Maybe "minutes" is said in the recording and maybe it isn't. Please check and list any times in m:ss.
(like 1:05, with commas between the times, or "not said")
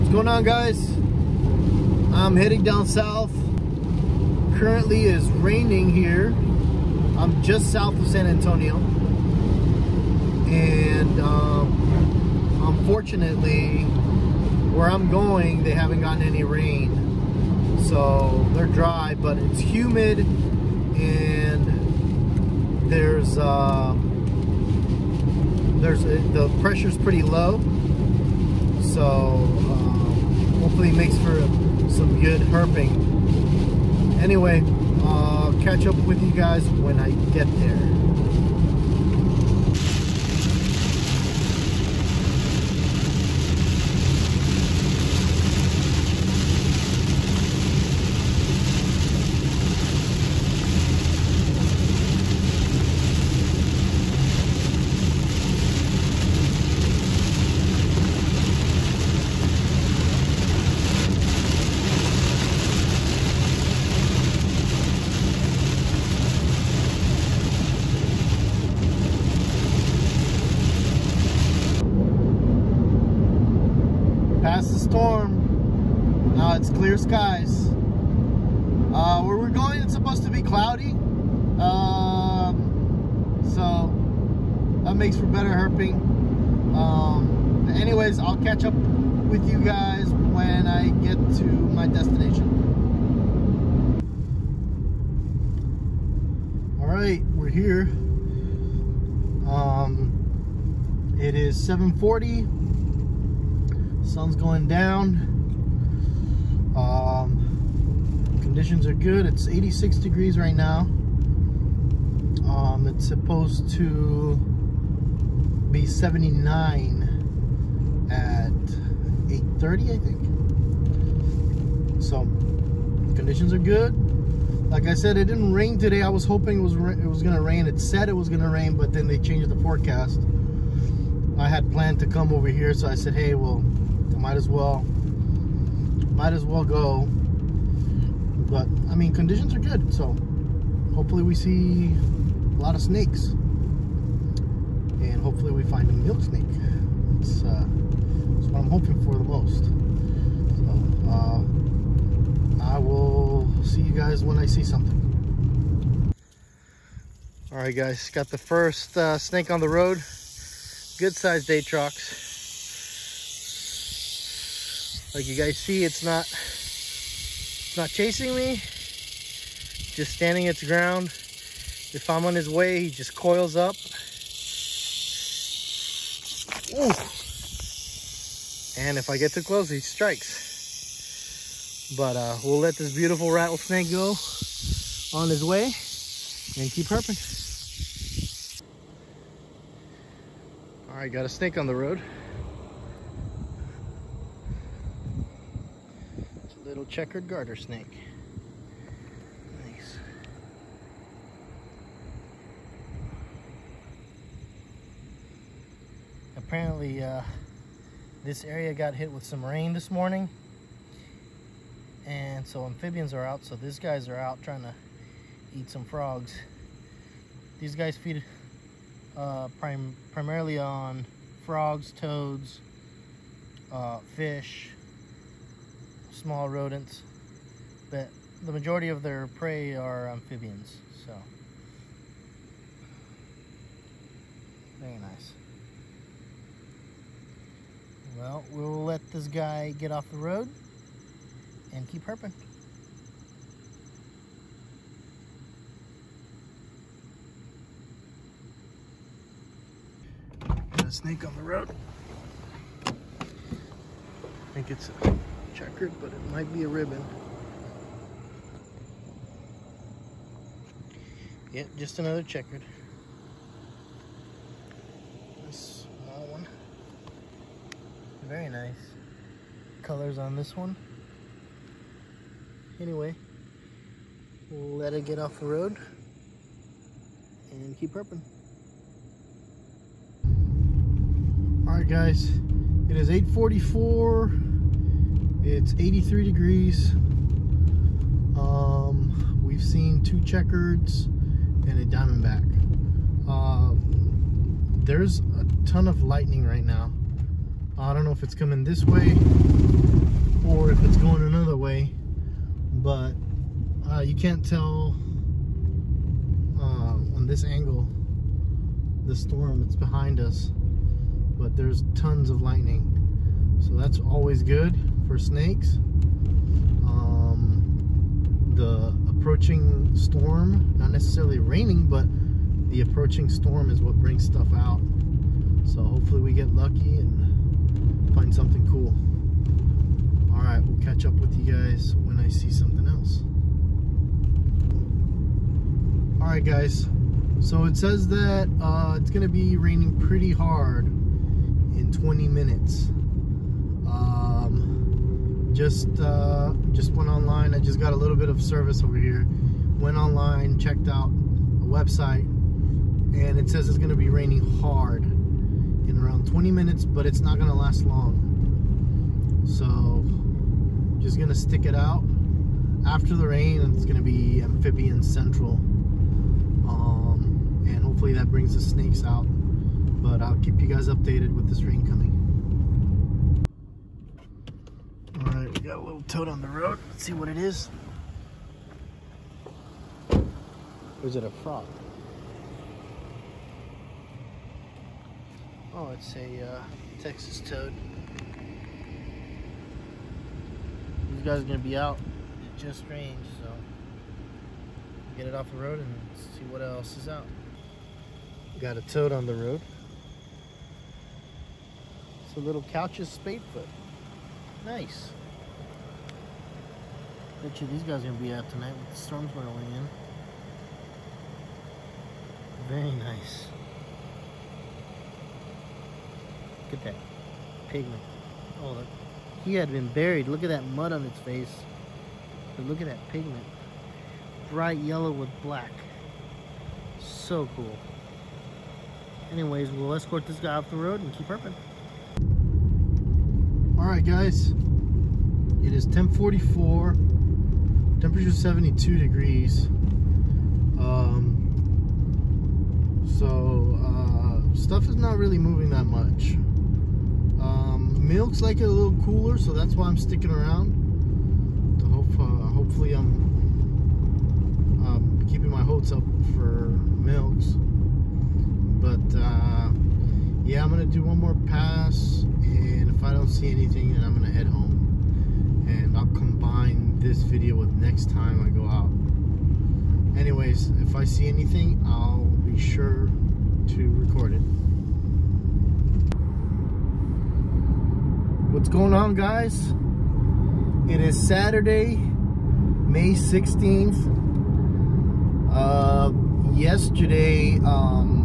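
5:42, 5:56.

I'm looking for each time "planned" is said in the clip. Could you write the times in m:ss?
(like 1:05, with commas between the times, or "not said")
2:11.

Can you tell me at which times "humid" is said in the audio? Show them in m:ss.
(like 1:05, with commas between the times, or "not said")
0:19.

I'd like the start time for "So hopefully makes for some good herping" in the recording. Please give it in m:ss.
0:28.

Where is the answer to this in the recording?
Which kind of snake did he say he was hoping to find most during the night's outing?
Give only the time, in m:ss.
2:25.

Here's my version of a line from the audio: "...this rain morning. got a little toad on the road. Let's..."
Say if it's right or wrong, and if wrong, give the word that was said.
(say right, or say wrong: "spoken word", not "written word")
wrong: "coming", not "morning".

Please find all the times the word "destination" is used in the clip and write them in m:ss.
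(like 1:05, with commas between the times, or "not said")
1:31.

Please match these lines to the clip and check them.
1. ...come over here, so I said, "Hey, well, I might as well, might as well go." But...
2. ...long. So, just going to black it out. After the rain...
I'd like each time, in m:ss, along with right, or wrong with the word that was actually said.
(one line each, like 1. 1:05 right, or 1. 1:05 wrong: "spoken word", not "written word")
1. 2:12 right
2. 5:57 wrong: "stick", not "black".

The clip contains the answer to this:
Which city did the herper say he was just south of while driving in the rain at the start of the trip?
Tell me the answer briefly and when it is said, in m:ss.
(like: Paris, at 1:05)
San Antonio, at 0:08.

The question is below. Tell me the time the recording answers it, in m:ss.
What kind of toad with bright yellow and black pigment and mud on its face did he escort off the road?
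6:42.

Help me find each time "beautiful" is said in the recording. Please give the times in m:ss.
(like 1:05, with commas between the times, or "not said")
3:02.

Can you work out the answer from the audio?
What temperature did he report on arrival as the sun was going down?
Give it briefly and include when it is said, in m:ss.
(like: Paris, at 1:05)
86 degrees, at 1:49.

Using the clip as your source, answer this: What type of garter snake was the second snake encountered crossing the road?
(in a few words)
checkered garter snake.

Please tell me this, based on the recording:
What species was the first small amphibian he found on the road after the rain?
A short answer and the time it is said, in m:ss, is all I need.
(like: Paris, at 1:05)
Texas toad, at 6:27.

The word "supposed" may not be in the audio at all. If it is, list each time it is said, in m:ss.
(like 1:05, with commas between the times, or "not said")
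1:19, 1:53.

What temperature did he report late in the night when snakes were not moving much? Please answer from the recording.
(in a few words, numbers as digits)
72 degrees.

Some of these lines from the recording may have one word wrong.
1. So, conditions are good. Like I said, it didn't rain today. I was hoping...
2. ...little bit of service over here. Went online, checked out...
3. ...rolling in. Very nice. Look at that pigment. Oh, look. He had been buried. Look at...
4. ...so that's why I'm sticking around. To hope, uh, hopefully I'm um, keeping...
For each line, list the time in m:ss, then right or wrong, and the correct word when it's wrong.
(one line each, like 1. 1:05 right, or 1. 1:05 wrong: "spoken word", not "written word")
1. 2:02 right
2. 5:47 right
3. 6:49 right
4. 7:29 right.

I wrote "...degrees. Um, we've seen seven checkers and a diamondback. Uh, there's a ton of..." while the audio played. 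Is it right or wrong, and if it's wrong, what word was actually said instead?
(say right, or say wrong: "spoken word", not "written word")
wrong: "two", not "seven".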